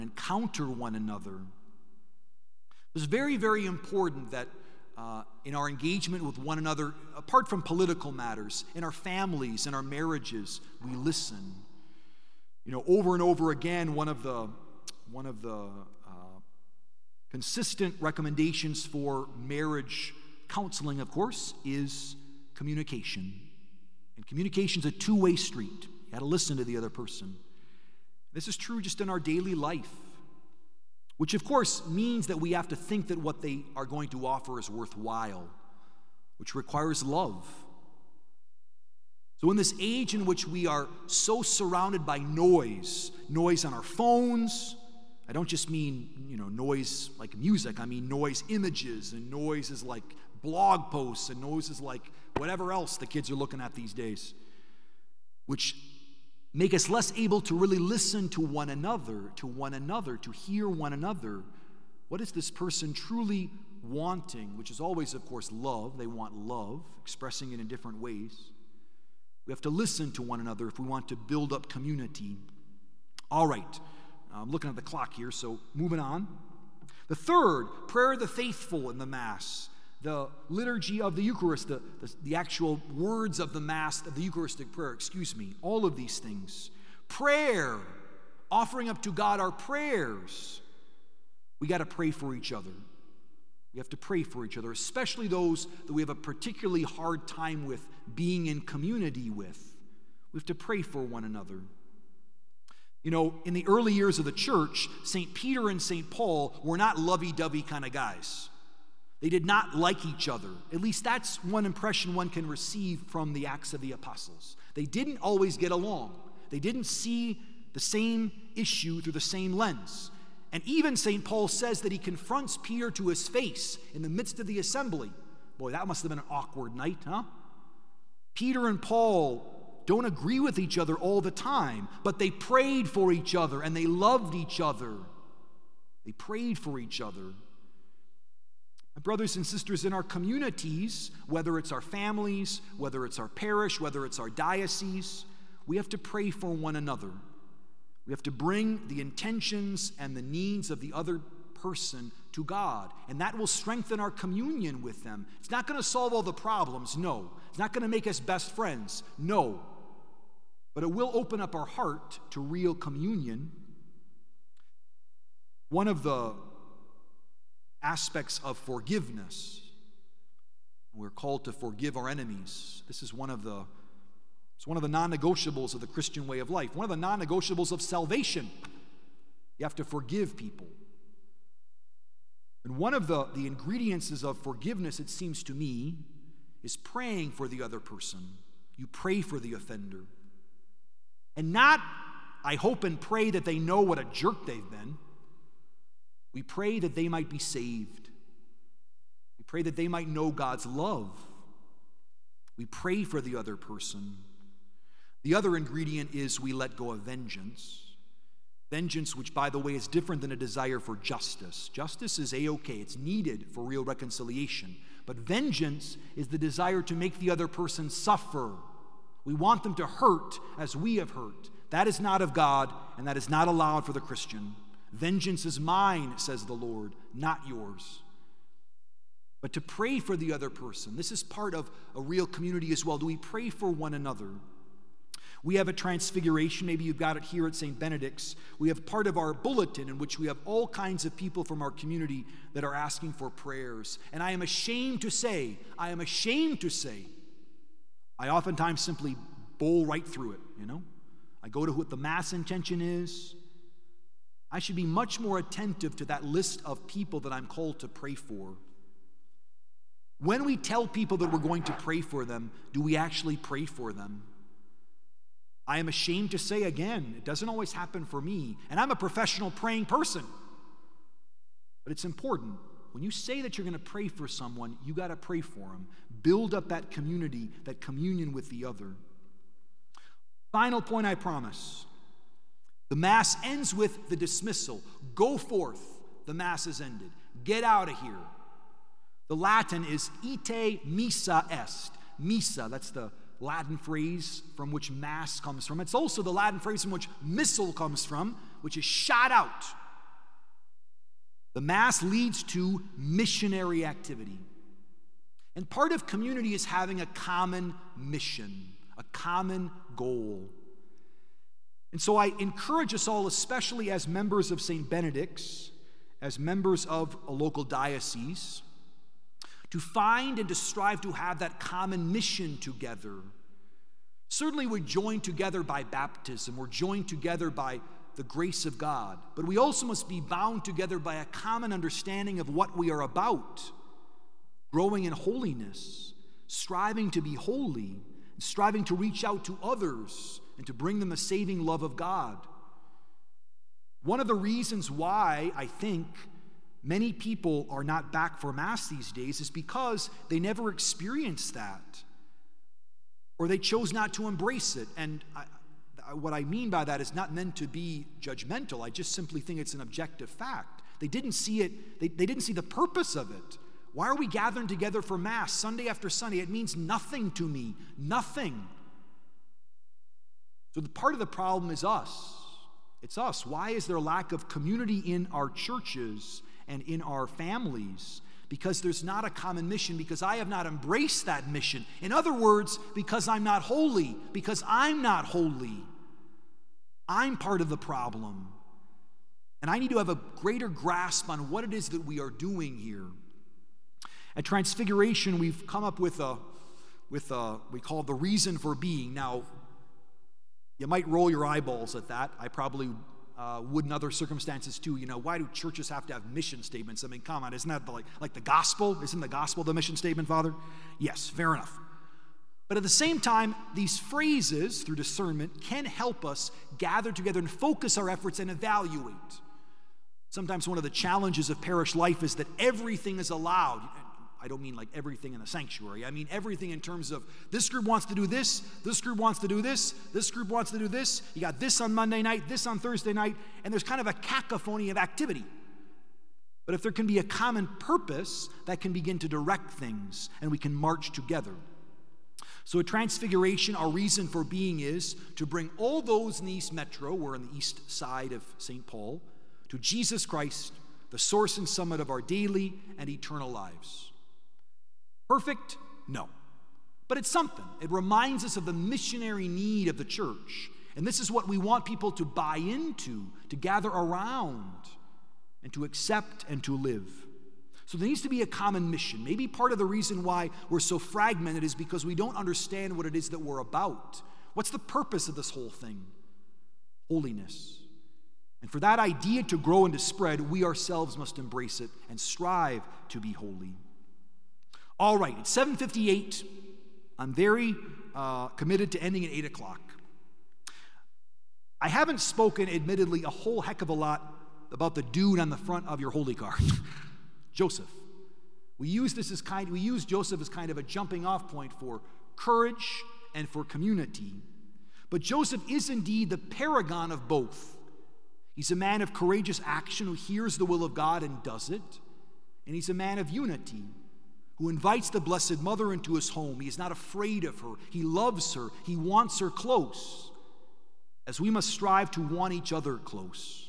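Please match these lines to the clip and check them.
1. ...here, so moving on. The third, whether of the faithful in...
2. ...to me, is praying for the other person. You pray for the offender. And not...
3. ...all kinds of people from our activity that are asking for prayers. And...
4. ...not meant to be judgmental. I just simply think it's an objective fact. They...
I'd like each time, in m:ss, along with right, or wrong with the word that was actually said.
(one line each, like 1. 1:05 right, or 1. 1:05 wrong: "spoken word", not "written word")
1. 1:15 wrong: "prayer", not "whether"
2. 3:05 right
3. 4:00 wrong: "community", not "activity"
4. 5:57 right.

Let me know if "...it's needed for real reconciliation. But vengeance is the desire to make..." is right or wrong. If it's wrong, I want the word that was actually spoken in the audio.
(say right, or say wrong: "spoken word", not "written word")
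right.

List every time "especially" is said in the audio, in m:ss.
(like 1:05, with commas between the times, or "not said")
1:34, 5:13.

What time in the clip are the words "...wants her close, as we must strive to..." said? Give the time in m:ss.
8:38.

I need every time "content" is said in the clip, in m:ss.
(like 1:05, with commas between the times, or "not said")
not said.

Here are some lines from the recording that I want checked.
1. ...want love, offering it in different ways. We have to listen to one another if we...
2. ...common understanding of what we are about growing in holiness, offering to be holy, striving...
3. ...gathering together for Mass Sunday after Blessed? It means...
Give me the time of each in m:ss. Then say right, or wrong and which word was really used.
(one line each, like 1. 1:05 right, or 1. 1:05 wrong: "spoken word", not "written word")
1. 1:06 wrong: "expressing", not "offering"
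2. 5:31 wrong: "striving", not "offering"
3. 6:04 wrong: "Sunday", not "Blessed".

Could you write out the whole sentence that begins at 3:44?
Vengeance is mine, says the Lord, not yours.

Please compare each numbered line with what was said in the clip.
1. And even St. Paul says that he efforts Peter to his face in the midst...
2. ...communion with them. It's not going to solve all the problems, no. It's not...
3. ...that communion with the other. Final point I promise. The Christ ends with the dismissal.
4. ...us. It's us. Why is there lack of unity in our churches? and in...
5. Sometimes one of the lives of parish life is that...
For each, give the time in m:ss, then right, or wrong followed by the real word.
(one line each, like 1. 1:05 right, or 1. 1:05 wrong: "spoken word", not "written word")
1. 2:00 wrong: "confronts", not "efforts"
2. 2:34 right
3. 4:37 wrong: "Mass", not "Christ"
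4. 6:11 wrong: "community", not "unity"
5. 7:00 wrong: "challenges", not "lives".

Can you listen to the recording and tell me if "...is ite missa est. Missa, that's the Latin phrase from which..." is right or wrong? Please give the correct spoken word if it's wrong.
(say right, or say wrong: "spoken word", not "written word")
right.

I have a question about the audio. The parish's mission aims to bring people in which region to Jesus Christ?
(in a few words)
East Metro.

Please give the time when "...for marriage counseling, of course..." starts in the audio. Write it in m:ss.
0:18.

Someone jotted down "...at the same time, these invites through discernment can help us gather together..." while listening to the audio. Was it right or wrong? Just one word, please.
wrong.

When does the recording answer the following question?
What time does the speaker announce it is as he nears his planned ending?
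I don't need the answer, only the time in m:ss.
8:05.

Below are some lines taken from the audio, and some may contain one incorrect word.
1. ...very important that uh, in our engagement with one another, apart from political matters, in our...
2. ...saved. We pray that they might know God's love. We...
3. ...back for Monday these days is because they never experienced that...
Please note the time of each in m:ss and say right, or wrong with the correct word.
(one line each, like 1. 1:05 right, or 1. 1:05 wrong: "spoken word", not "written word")
1. 0:03 right
2. 3:17 right
3. 5:48 wrong: "Mass", not "Monday".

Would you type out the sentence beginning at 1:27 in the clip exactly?
Prayer, offering up to God our prayers.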